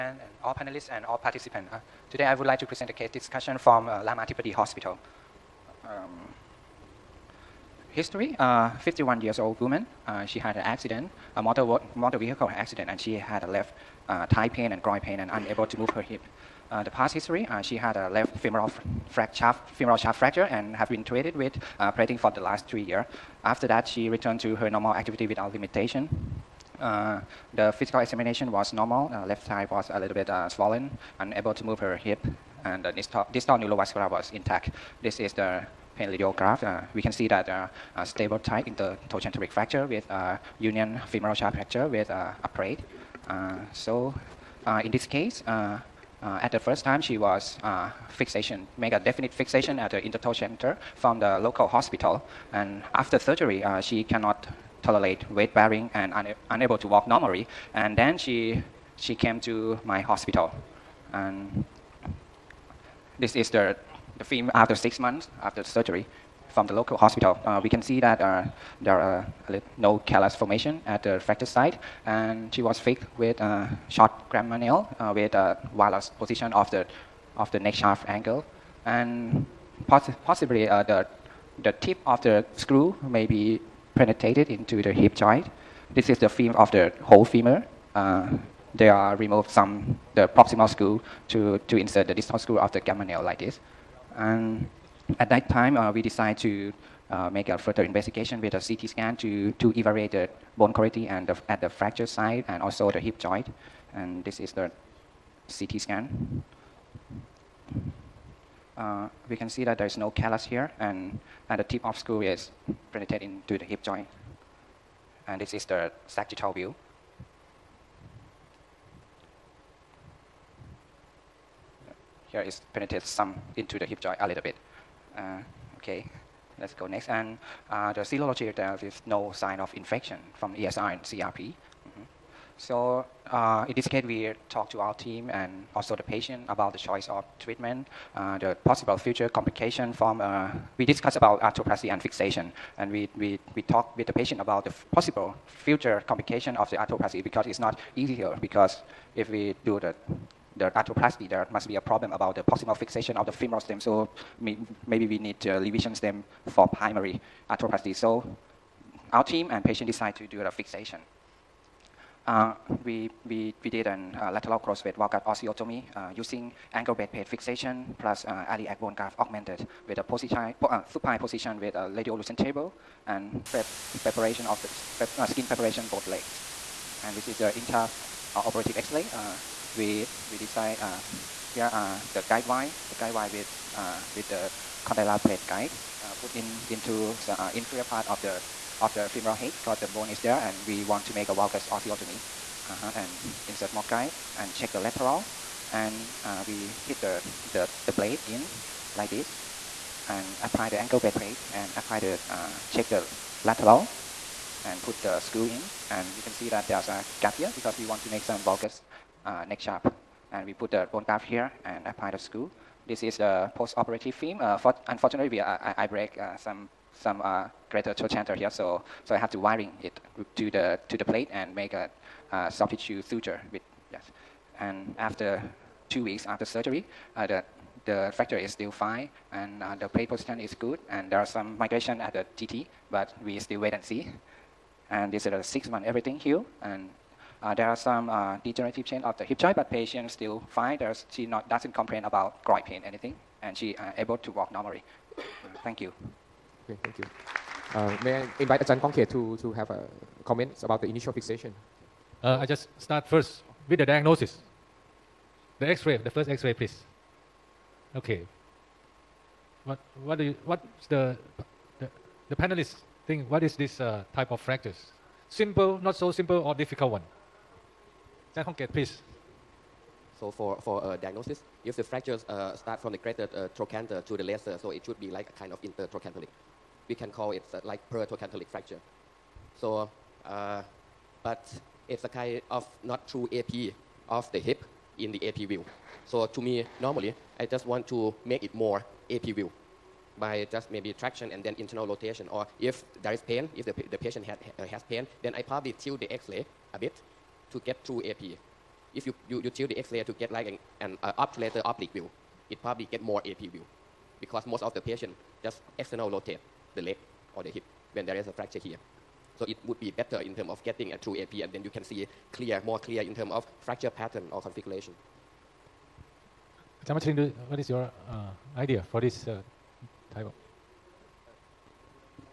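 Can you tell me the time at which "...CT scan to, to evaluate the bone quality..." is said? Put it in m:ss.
1:38.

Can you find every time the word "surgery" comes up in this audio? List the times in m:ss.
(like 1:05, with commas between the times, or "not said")
0:53, 1:05, 3:46.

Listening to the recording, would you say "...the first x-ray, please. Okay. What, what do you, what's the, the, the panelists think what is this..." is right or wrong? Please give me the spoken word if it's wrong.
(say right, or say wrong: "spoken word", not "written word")
right.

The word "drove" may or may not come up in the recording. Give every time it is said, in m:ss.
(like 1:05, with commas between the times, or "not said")
not said.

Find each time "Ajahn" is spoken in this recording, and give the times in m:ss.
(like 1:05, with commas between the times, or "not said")
4:08.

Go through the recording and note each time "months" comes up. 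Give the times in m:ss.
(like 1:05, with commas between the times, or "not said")
1:04, 3:55.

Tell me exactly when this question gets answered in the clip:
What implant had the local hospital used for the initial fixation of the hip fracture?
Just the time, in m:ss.
1:13.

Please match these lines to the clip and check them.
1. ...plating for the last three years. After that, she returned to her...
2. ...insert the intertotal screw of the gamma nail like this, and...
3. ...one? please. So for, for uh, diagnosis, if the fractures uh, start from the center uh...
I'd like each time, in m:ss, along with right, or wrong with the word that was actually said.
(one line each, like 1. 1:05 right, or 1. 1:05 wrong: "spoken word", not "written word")
1. 0:21 right
2. 1:31 wrong: "distal", not "intertotal"
3. 4:26 wrong: "greater", not "center".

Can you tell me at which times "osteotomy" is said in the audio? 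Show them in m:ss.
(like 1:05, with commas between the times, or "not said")
2:45, 3:11.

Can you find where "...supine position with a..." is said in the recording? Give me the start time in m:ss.
2:50.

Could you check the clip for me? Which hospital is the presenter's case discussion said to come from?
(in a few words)
Ramathibodi Hospital.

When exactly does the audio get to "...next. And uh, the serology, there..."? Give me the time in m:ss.
2:06.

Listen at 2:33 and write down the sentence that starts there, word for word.
So maybe we need revision uh, stem for primary arthroplasty.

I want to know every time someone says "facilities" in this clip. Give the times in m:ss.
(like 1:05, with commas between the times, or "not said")
not said.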